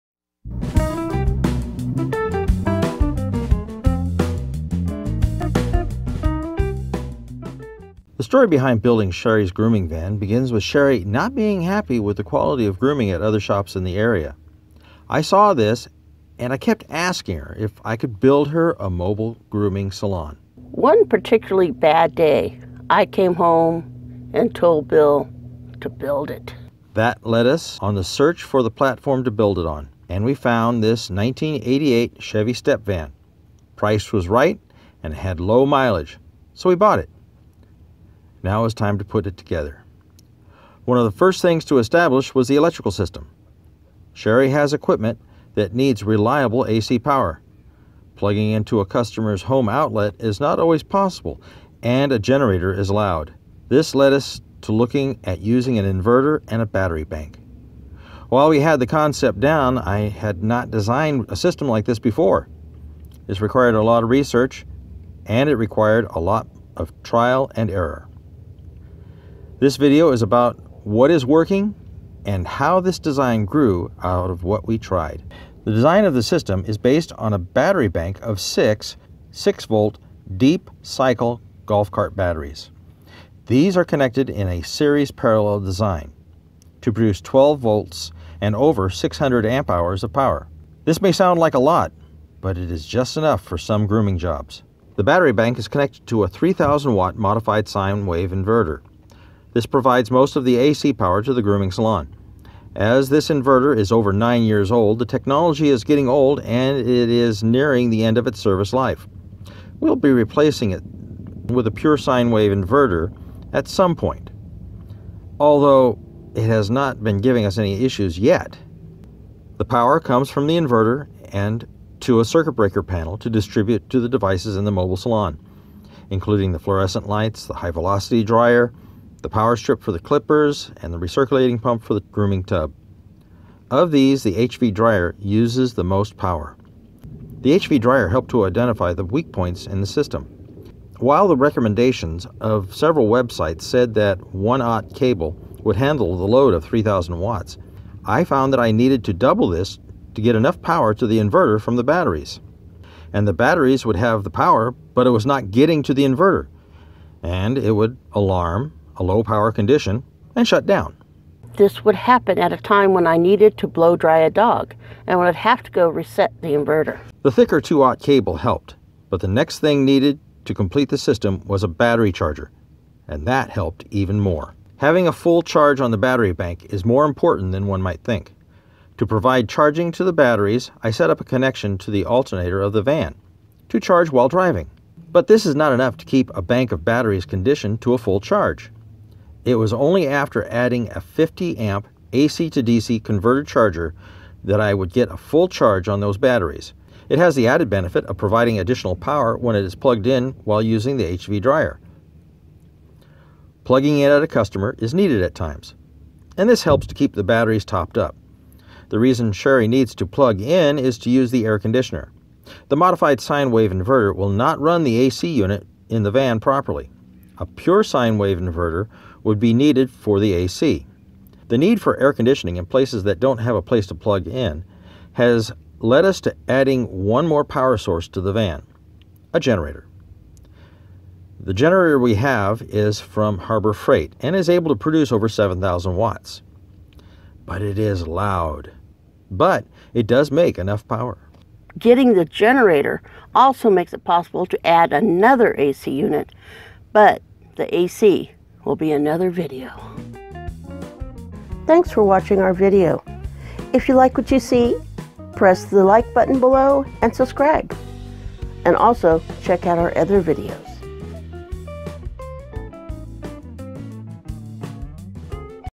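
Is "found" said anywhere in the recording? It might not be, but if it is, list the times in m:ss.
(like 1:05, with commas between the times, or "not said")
0:30, 2:28.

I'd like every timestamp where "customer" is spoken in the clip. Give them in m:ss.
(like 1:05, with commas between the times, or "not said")
0:48, 3:24.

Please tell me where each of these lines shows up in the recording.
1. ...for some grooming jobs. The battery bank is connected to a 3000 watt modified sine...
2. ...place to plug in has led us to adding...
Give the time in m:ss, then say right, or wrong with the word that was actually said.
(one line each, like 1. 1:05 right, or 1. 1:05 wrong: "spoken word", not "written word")
1. 1:33 right
2. 3:43 right.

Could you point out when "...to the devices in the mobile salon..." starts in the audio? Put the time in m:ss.
2:03.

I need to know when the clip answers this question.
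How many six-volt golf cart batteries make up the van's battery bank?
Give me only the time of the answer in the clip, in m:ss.
1:18.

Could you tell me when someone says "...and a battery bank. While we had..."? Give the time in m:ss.
0:56.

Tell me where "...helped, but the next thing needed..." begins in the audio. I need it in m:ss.
2:48.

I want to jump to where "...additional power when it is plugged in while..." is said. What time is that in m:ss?
3:18.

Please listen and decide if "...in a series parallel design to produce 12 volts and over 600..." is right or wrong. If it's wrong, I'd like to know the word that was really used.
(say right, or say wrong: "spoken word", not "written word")
right.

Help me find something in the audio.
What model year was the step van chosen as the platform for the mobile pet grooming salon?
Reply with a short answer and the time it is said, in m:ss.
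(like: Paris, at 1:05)
1988, at 0:31.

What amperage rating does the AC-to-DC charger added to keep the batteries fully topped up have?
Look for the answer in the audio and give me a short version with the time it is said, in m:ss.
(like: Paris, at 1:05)
50 amp, at 3:11.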